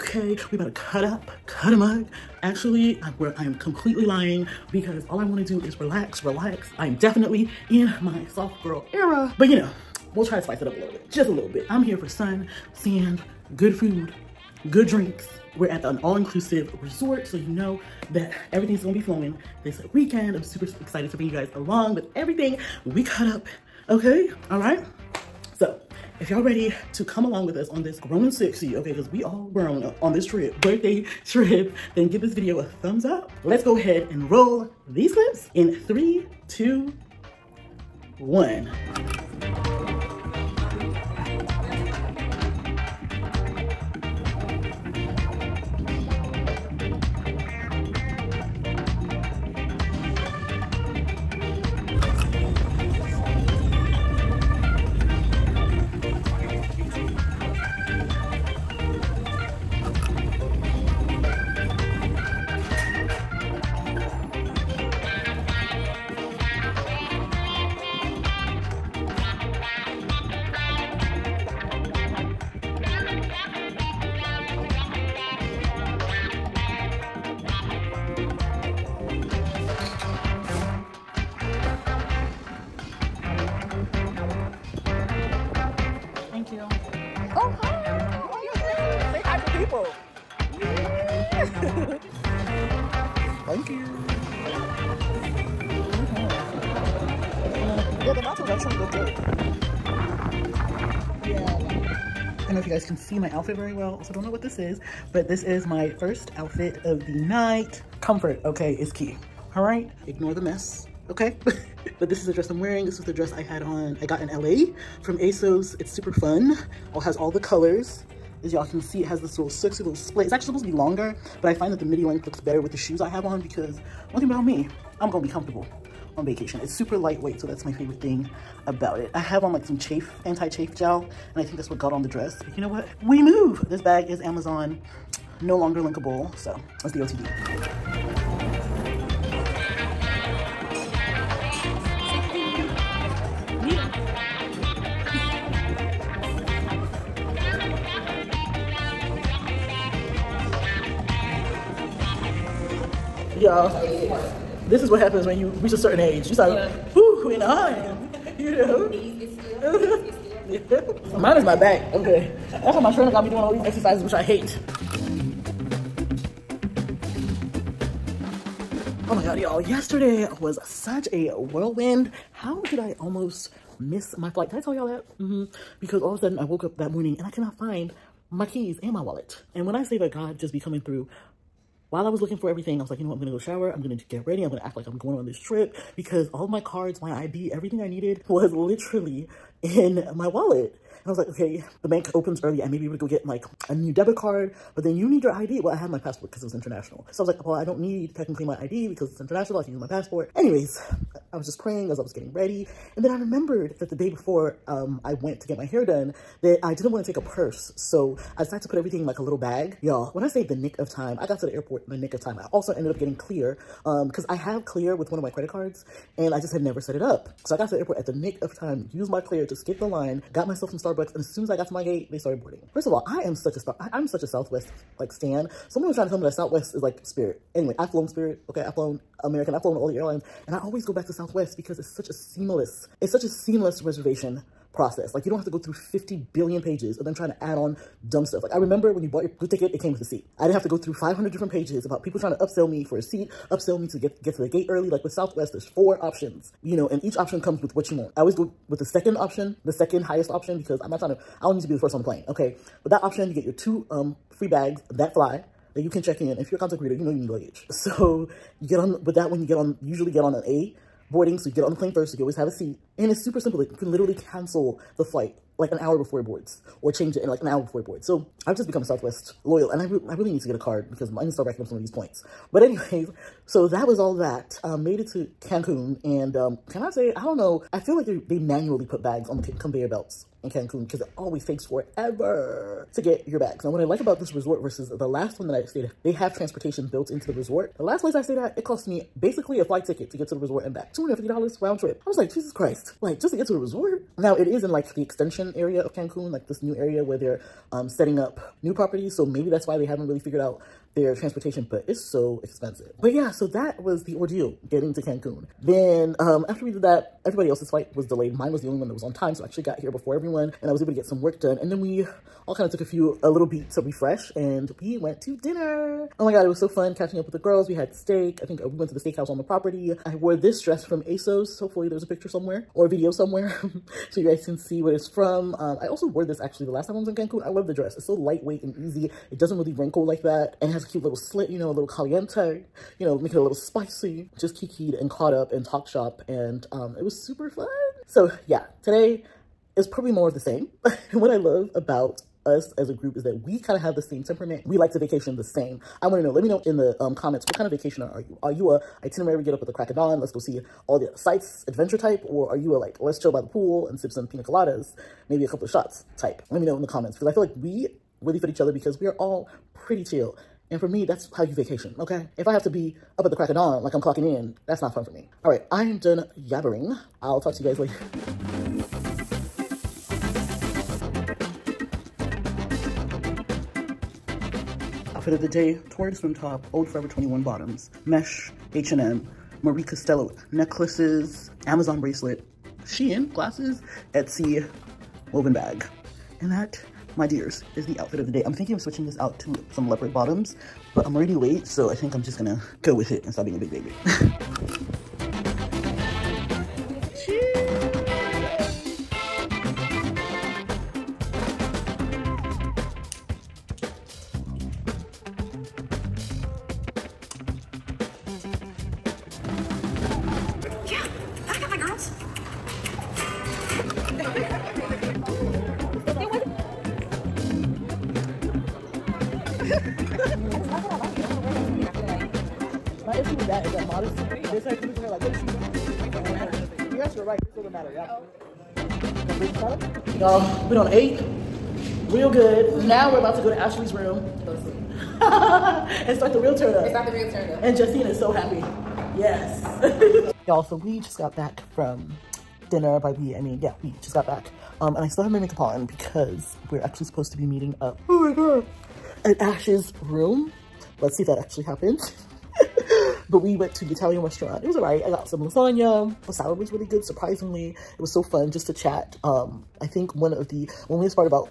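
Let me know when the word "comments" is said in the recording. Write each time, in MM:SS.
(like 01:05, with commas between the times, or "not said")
05:47, 05:56.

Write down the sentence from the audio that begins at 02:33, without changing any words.
yeah this is what happens when you reach a certain age.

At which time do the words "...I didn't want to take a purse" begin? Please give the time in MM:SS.
03:26.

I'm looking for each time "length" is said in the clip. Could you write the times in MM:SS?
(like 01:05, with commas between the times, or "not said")
02:02.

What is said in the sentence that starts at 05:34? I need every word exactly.
Just kikied and caught up and talked shop and um, it was super fun.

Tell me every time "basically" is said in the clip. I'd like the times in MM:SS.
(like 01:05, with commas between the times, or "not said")
04:49.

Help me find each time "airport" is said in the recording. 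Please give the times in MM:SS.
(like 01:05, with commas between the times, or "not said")
03:31, 03:37.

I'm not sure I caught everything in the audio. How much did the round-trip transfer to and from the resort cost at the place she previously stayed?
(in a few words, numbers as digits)
$250.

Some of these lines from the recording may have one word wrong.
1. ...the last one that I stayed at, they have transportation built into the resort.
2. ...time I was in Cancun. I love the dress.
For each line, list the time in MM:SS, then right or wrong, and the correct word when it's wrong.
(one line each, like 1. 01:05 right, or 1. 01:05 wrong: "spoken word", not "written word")
1. 04:44 right
2. 05:26 right.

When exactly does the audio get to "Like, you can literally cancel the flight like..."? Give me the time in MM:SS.
04:23.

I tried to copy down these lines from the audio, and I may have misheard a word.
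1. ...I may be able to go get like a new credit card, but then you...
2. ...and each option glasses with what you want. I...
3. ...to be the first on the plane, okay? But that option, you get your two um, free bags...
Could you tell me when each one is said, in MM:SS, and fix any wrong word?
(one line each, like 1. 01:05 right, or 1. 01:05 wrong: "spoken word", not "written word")
1. 03:12 wrong: "debit", not "credit"
2. 04:06 wrong: "comes", not "glasses"
3. 04:11 right.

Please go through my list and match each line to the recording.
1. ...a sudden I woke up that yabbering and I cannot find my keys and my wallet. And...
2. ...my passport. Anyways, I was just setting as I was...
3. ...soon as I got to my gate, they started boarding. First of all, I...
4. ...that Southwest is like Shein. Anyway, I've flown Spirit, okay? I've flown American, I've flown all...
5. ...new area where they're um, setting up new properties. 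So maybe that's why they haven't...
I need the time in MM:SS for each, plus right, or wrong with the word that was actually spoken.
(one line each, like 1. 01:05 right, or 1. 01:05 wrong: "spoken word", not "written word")
1. 02:56 wrong: "morning", not "yabbering"
2. 03:19 wrong: "praying", not "setting"
3. 03:41 right
4. 03:46 wrong: "Spirit", not "Shein"
5. 04:56 right.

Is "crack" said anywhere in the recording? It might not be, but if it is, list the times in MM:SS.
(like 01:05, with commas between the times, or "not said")
05:49, 06:03.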